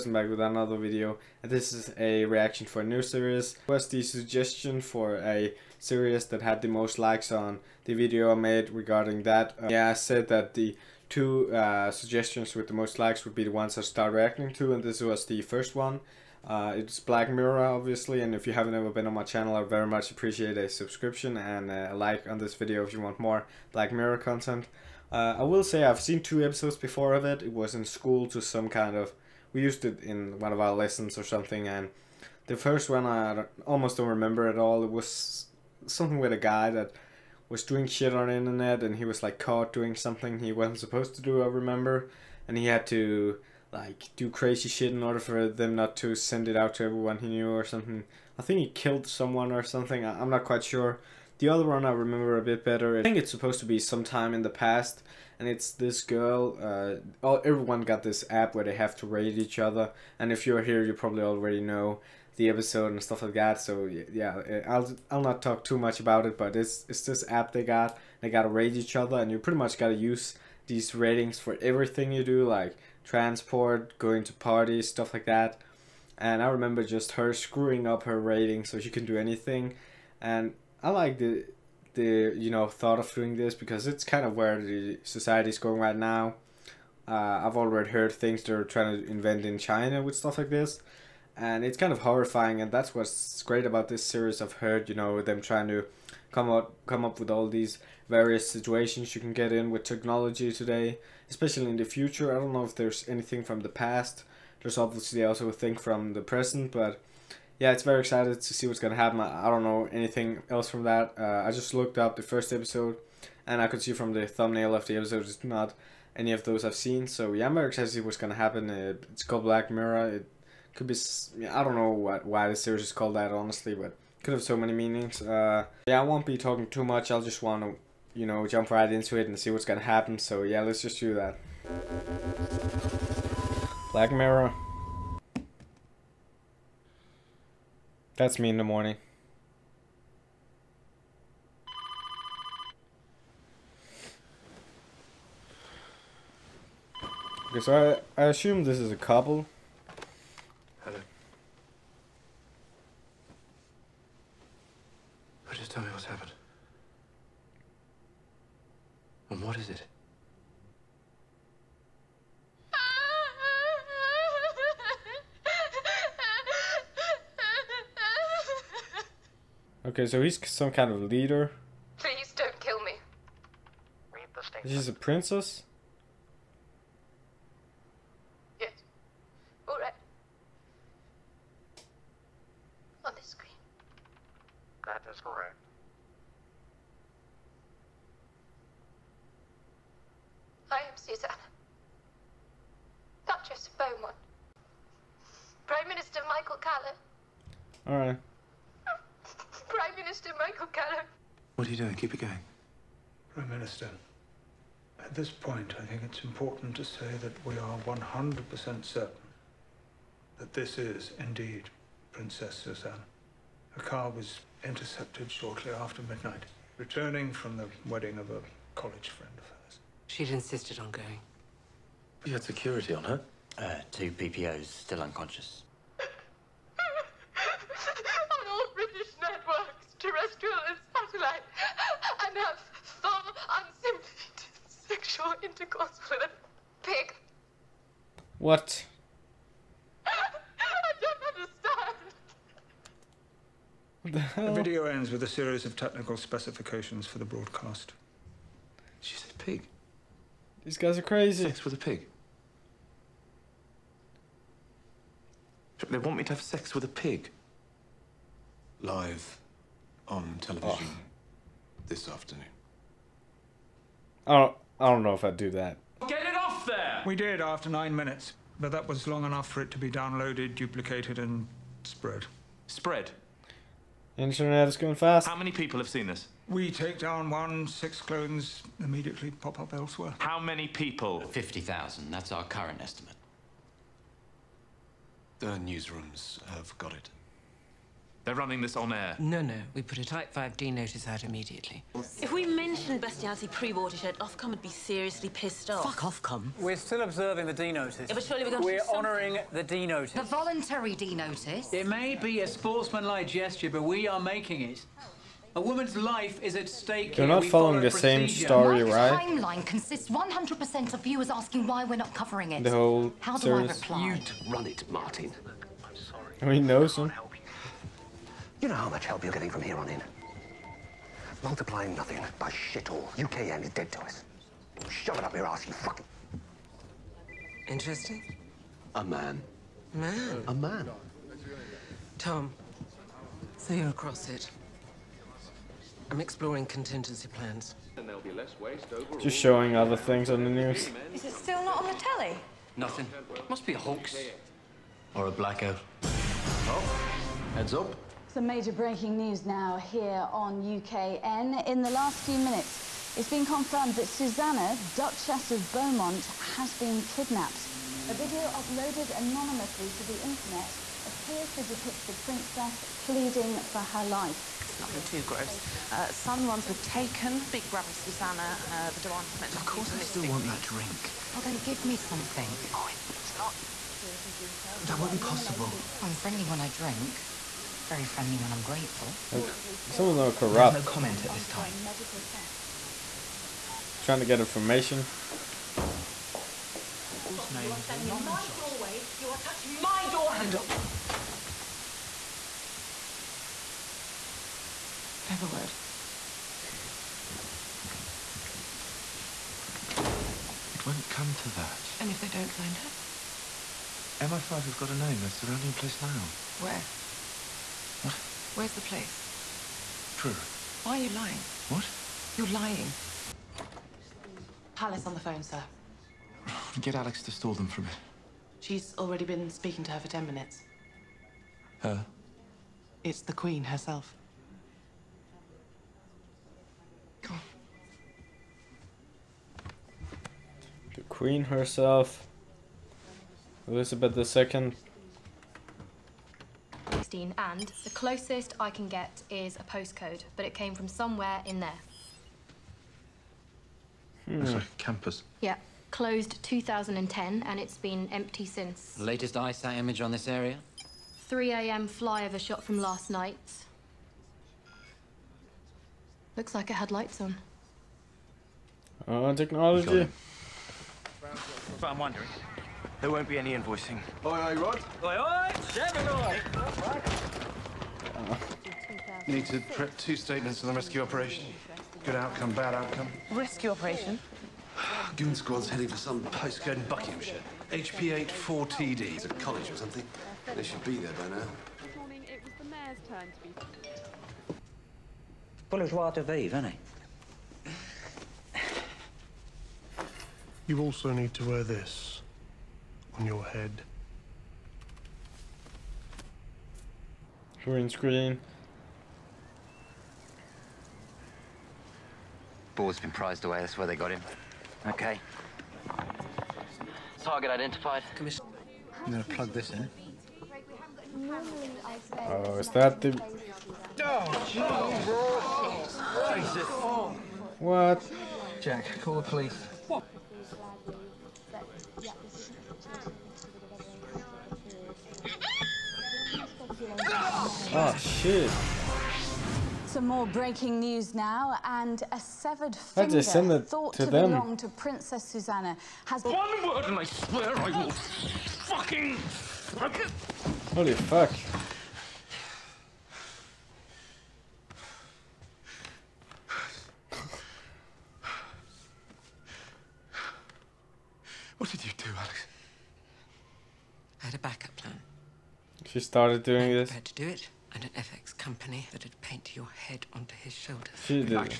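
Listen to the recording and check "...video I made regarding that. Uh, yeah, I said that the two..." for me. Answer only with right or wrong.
right.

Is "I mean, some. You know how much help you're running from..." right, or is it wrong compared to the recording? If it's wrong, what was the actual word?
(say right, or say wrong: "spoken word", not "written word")
wrong: "getting", not "running".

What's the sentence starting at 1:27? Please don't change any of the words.
Uh, I've already heard things they're trying to invent in China with stuff like this, and it's kind of horrifying.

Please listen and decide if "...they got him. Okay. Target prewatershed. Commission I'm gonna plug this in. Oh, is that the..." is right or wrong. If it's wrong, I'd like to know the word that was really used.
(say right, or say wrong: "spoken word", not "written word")
wrong: "identified", not "prewatershed".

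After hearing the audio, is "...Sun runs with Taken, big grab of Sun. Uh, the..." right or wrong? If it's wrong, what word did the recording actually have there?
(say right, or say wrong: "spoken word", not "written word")
wrong: "Susanna", not "Sun".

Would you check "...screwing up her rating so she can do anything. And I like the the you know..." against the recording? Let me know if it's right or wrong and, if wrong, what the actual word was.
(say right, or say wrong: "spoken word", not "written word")
right.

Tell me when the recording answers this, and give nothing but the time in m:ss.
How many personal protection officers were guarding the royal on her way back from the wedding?
3:43.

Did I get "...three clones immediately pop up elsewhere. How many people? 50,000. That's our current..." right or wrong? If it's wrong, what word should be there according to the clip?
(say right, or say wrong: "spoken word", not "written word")
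wrong: "six", not "three".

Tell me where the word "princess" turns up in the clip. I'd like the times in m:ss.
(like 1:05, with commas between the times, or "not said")
2:54, 3:32, 6:02, 8:54.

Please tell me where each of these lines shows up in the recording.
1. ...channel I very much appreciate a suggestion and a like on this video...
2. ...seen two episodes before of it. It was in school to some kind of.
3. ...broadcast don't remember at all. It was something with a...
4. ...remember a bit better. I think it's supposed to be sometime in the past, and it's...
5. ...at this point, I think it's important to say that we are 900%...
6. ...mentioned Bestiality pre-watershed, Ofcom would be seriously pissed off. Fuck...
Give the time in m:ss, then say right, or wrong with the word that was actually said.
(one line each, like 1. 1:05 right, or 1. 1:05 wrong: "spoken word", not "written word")
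1. 0:19 wrong: "subscription", not "suggestion"
2. 0:25 right
3. 0:33 wrong: "almost", not "broadcast"
4. 0:51 right
5. 3:25 wrong: "100", not "900"
6. 4:52 right.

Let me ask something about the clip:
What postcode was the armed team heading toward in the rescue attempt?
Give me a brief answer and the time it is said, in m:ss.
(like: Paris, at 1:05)
HP84TD, at 7:57.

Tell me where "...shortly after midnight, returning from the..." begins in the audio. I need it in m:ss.
3:35.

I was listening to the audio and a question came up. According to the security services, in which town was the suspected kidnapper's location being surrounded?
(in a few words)
Truro.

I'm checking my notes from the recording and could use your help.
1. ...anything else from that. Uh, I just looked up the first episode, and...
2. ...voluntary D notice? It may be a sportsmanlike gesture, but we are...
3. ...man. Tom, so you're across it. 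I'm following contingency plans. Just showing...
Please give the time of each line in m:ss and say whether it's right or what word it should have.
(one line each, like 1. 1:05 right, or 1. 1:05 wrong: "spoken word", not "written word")
1. 1:49 right
2. 5:00 right
3. 5:30 wrong: "exploring", not "following".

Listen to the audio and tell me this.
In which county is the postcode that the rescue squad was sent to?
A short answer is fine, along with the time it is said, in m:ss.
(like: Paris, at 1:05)
Buckinghamshire, at 7:56.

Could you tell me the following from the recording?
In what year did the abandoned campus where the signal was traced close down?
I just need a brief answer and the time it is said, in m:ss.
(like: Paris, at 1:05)
2010, at 7:25.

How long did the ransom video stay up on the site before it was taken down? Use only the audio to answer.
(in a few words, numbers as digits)
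9 minutes.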